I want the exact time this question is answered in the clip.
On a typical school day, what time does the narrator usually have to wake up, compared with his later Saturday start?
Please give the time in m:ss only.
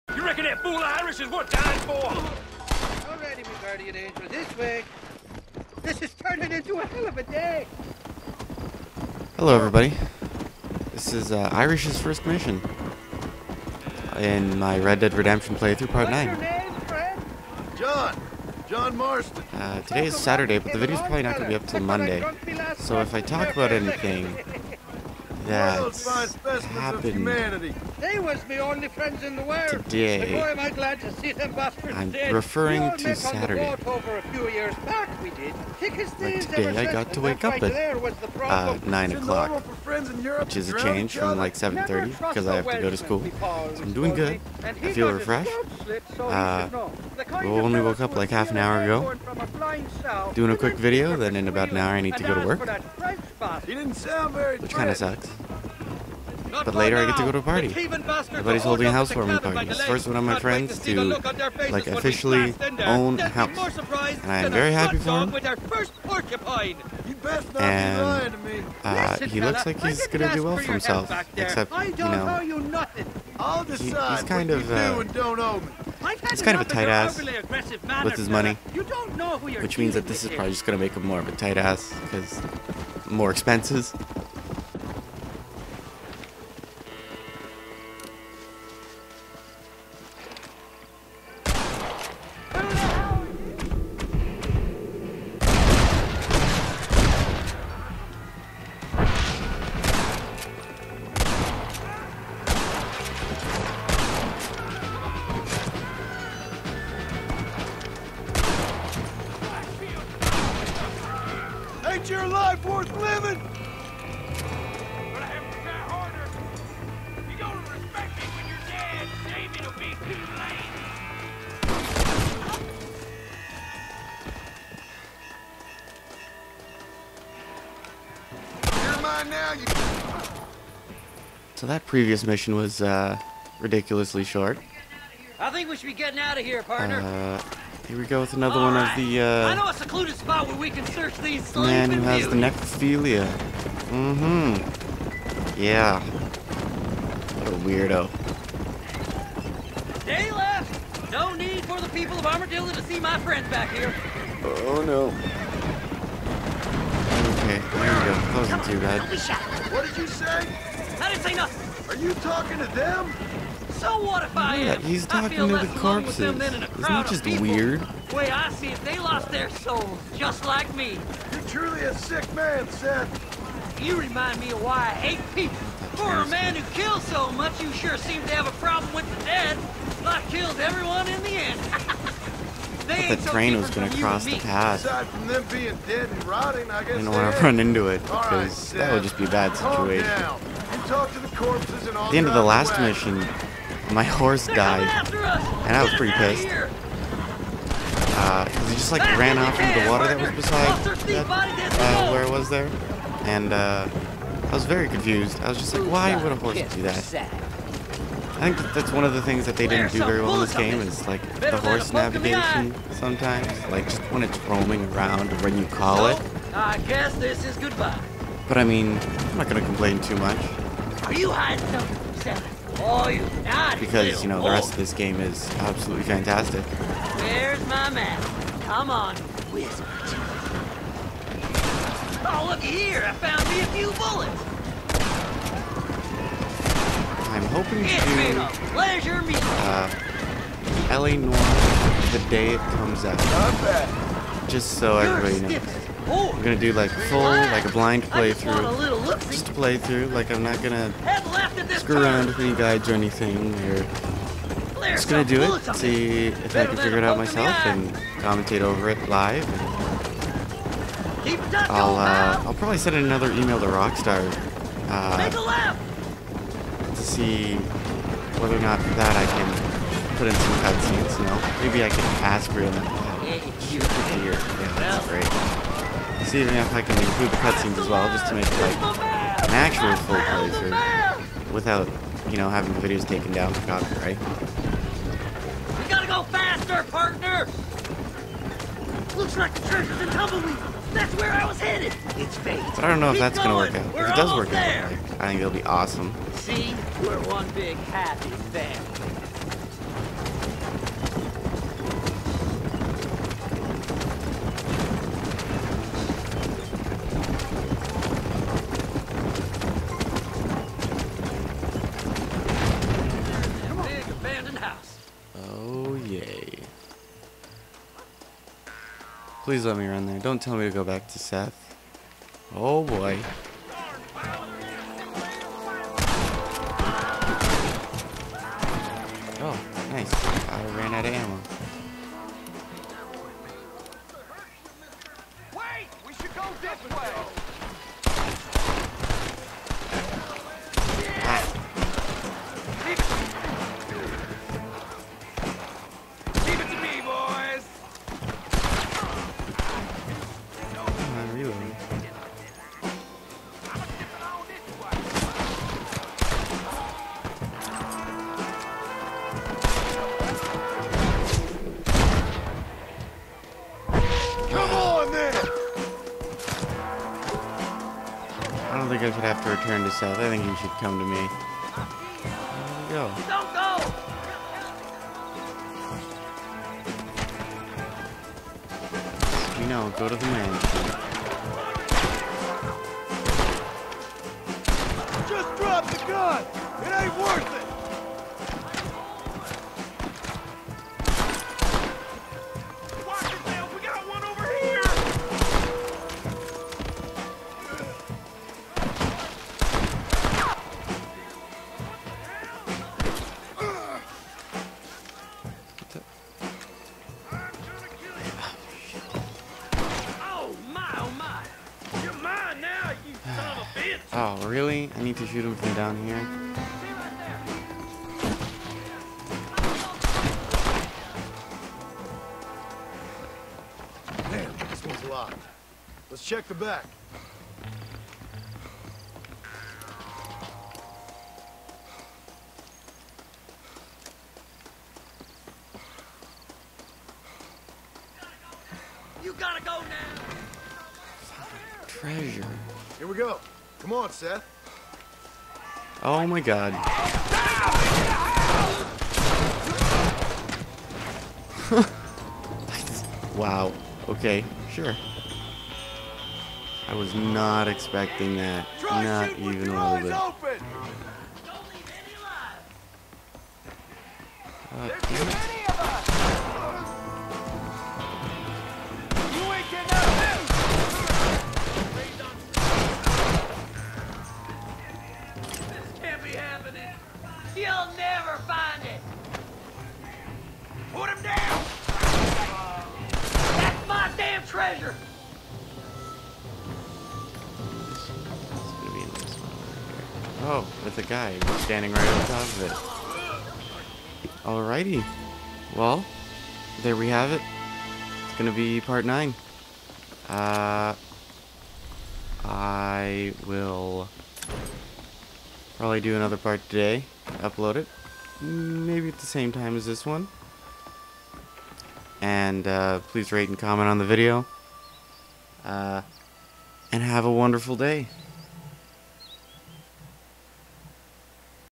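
0:41.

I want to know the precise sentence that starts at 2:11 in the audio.
So that previous mission was uh, ridiculously short.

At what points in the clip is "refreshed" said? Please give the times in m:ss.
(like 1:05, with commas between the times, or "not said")
0:45.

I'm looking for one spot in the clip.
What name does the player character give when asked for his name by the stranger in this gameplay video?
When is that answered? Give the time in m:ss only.
0:18.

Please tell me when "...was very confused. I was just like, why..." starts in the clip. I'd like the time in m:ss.
3:24.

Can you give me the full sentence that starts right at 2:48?
The way I see it, they lost their souls, just like me.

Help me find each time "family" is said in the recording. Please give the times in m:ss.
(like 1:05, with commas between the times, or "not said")
4:58.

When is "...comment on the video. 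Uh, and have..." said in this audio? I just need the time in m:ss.
8:33.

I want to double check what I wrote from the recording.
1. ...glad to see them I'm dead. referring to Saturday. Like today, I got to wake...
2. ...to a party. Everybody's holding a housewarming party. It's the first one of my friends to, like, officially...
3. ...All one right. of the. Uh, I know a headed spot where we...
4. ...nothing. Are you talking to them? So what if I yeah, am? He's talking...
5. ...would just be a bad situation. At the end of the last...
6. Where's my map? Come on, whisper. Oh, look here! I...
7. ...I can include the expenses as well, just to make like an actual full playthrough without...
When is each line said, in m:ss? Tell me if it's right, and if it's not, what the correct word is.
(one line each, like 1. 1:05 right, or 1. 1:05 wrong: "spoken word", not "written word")
1. 0:30 right
2. 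0:57 right
3. 2:18 wrong: "secluded", not "headed"
4. 2:41 right
5. 3:08 right
6. 3:47 right
7. 4:36 wrong: "cutscenes", not "expenses".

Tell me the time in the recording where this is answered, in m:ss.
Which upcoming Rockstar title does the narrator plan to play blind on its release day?
4:00.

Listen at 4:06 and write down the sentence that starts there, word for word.
I'm gonna do like full, like a blind playthrough.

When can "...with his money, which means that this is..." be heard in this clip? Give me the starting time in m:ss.
1:18.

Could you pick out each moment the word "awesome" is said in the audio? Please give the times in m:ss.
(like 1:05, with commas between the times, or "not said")
4:55.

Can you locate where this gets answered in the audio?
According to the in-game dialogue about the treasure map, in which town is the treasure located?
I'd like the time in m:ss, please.
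4:50.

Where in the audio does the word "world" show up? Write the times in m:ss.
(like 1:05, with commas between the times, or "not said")
0:29.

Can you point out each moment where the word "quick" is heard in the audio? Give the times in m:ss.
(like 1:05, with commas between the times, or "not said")
0:50.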